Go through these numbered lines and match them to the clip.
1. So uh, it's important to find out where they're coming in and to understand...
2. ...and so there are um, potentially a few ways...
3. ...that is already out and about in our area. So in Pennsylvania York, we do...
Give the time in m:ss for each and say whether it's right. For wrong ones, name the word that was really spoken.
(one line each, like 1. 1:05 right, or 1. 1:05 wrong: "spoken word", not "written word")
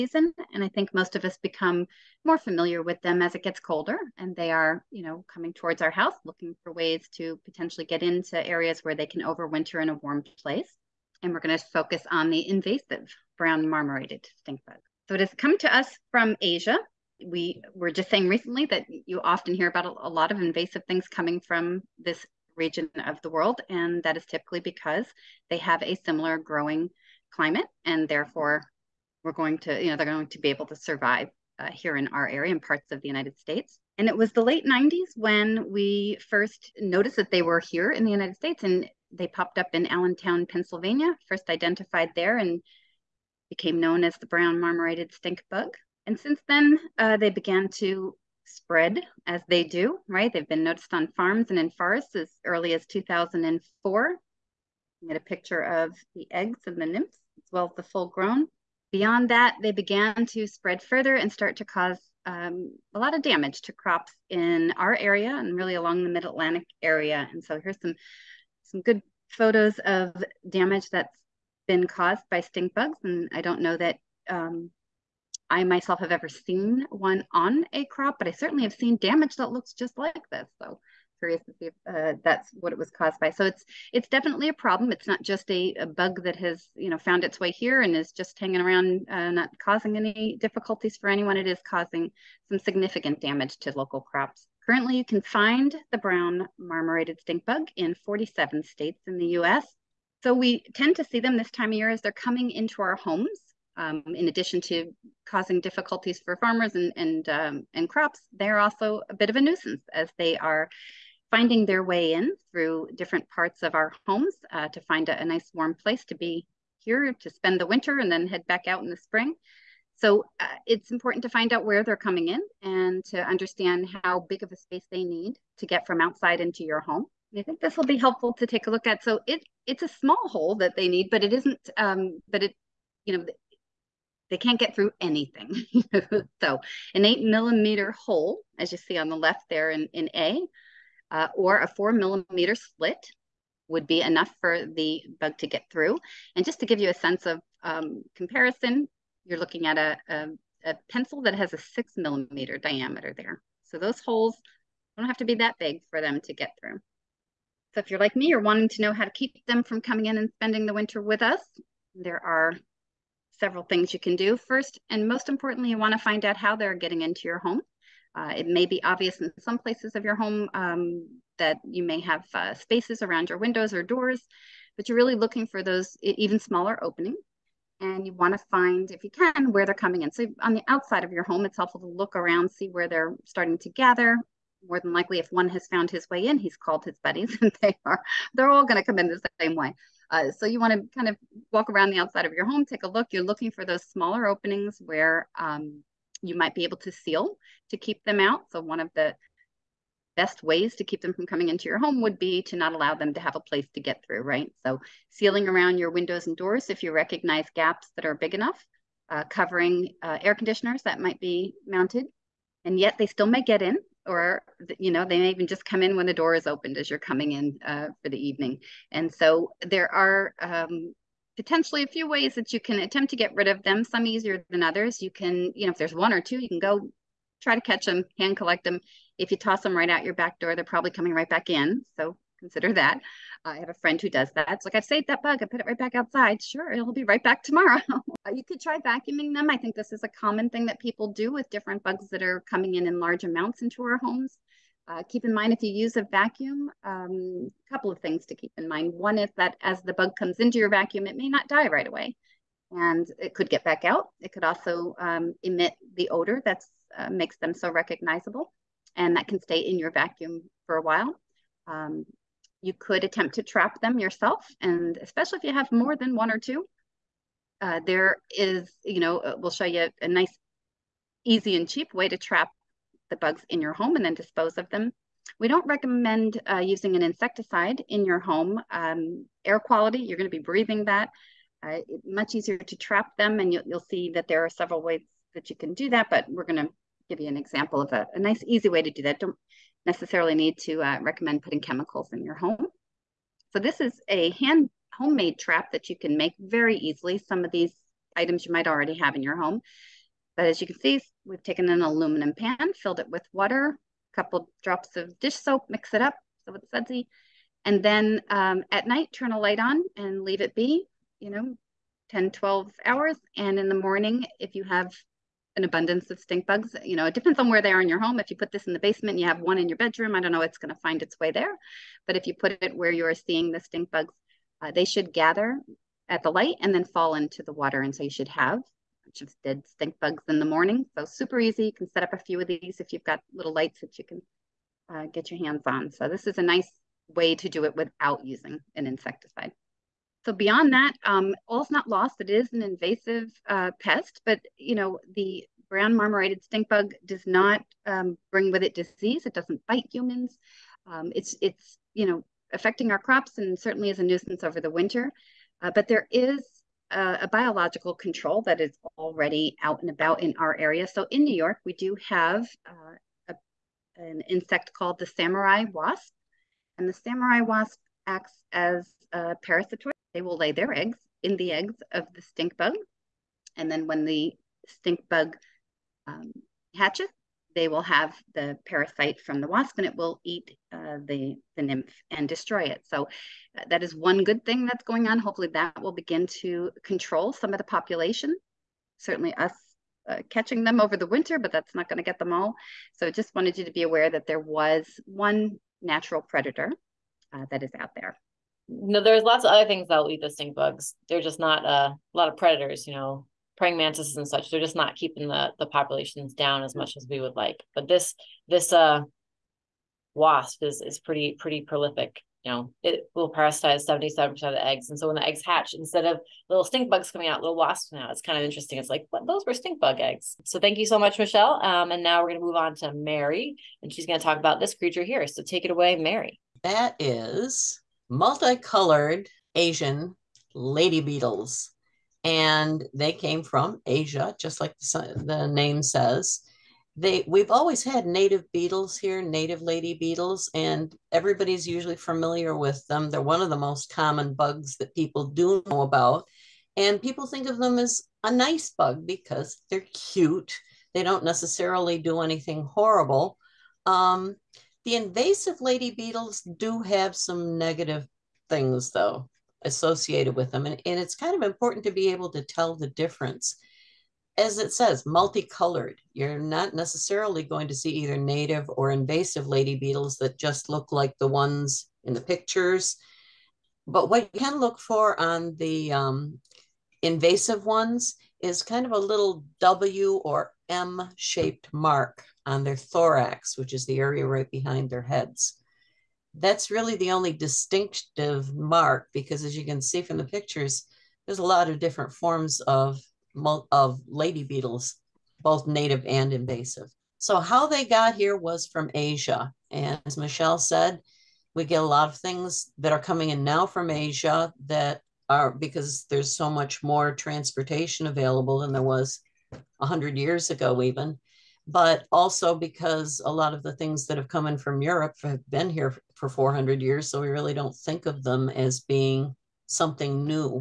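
1. 1:59 right
2. 3:38 right
3. 5:58 wrong: "New", not "Pennsylvania".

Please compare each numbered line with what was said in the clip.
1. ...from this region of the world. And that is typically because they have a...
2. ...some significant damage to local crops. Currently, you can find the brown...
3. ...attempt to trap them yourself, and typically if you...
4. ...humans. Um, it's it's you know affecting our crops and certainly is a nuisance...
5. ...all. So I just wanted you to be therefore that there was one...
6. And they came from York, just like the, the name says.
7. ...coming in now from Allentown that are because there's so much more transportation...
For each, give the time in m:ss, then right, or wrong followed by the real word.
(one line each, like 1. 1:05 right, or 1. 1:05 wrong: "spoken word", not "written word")
1. 0:21 right
2. 1:32 right
3. 4:23 wrong: "especially", not "typically"
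4. 5:49 right
5. 6:32 wrong: "aware", not "therefore"
6. 7:12 wrong: "Asia", not "York"
7. 8:22 wrong: "Asia", not "Allentown".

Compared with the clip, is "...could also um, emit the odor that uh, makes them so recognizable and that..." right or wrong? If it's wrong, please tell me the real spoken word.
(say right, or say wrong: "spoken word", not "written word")
right.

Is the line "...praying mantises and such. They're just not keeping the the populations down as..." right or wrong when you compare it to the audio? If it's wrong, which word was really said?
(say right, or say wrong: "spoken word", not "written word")
right.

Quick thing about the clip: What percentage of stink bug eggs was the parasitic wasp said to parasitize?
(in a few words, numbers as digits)
77%.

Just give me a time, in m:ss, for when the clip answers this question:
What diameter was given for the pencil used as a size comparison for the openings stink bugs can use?
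2:31.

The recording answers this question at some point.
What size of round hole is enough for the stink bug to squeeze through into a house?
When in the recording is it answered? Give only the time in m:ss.
2:17.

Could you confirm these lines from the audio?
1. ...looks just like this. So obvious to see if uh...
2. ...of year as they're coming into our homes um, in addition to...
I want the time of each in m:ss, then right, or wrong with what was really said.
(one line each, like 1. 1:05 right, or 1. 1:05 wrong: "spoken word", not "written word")
1. 1:19 wrong: "curious", not "obvious"
2. 1:41 right.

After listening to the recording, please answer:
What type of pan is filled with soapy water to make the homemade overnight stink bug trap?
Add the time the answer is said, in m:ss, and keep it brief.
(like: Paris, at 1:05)
aluminum pan, at 5:01.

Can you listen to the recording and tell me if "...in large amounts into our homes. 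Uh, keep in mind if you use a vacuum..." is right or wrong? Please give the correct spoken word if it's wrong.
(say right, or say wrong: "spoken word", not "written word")
right.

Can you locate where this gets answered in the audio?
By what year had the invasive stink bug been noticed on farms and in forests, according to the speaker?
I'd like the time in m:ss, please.
0:52.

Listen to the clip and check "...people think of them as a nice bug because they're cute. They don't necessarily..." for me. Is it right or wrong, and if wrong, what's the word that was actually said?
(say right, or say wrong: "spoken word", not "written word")
right.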